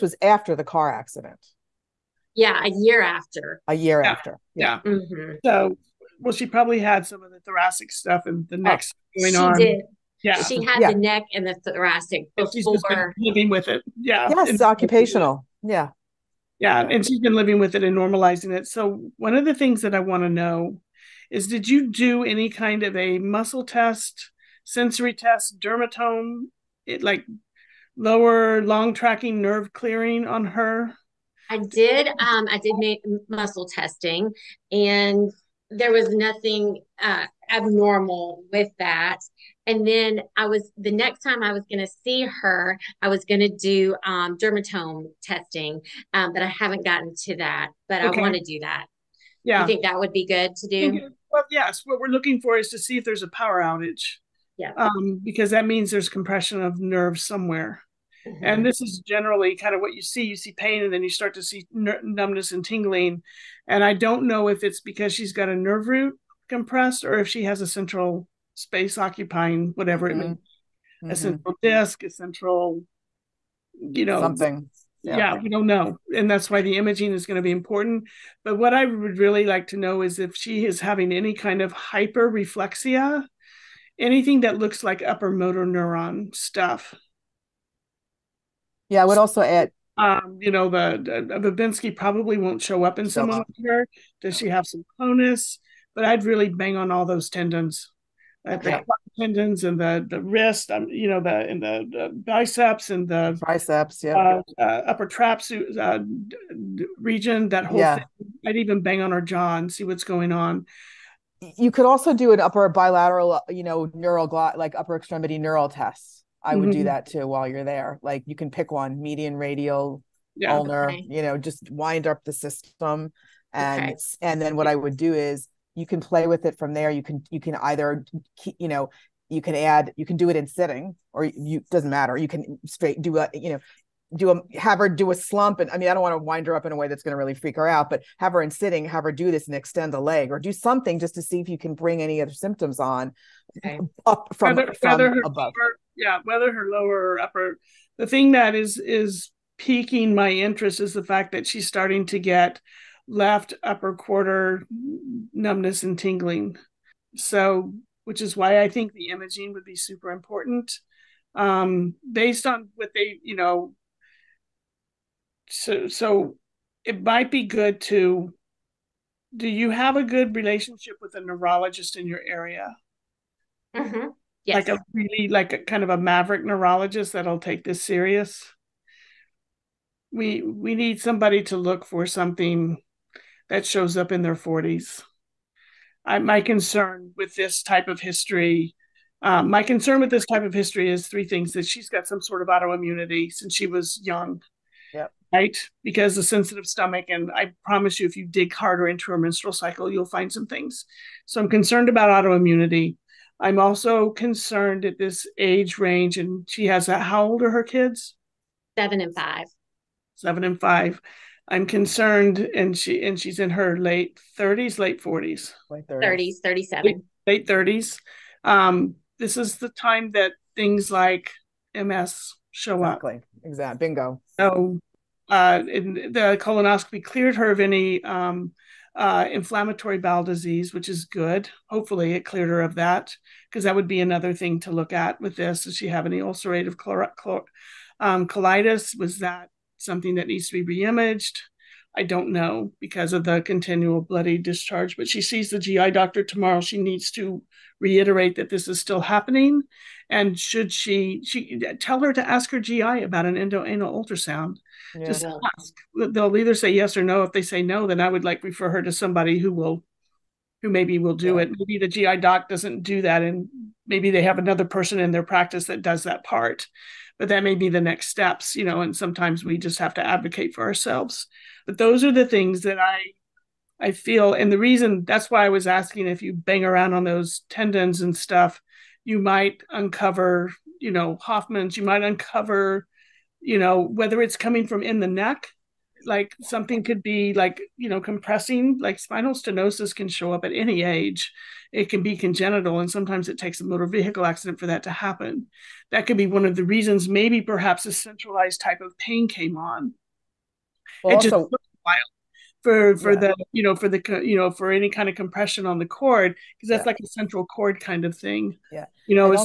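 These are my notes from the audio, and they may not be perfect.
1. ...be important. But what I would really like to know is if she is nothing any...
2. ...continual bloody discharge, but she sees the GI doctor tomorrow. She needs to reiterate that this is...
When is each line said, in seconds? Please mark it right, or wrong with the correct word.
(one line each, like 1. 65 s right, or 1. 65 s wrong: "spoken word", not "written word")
1. 77 s wrong: "having", not "nothing"
2. 243 s right.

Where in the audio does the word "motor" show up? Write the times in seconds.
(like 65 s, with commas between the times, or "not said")
85 s, 293 s.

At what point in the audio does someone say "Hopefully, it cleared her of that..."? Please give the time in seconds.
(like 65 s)
231 s.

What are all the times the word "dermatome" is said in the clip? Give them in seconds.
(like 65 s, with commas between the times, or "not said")
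25 s, 44 s.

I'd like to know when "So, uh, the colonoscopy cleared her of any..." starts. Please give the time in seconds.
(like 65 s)
224 s.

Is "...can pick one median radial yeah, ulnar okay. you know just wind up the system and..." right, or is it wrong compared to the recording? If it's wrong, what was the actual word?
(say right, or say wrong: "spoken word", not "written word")
right.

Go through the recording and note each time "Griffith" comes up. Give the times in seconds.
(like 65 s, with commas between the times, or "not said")
not said.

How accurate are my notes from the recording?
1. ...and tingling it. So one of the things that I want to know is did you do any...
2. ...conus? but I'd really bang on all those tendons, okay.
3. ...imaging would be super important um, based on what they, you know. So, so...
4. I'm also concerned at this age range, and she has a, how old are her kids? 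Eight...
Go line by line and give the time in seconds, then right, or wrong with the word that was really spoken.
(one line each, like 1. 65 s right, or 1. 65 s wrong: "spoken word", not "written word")
1. 17 s wrong: "normalizing", not "tingling"
2. 95 s right
3. 159 s right
4. 203 s wrong: "Seven", not "Eight".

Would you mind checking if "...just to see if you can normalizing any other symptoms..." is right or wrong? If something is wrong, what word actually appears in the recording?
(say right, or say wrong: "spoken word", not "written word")
wrong: "bring", not "normalizing".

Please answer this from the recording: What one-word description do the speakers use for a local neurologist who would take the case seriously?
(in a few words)
maverick.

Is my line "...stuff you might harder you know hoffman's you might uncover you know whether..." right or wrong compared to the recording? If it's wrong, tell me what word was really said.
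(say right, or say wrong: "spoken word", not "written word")
wrong: "uncover", not "harder".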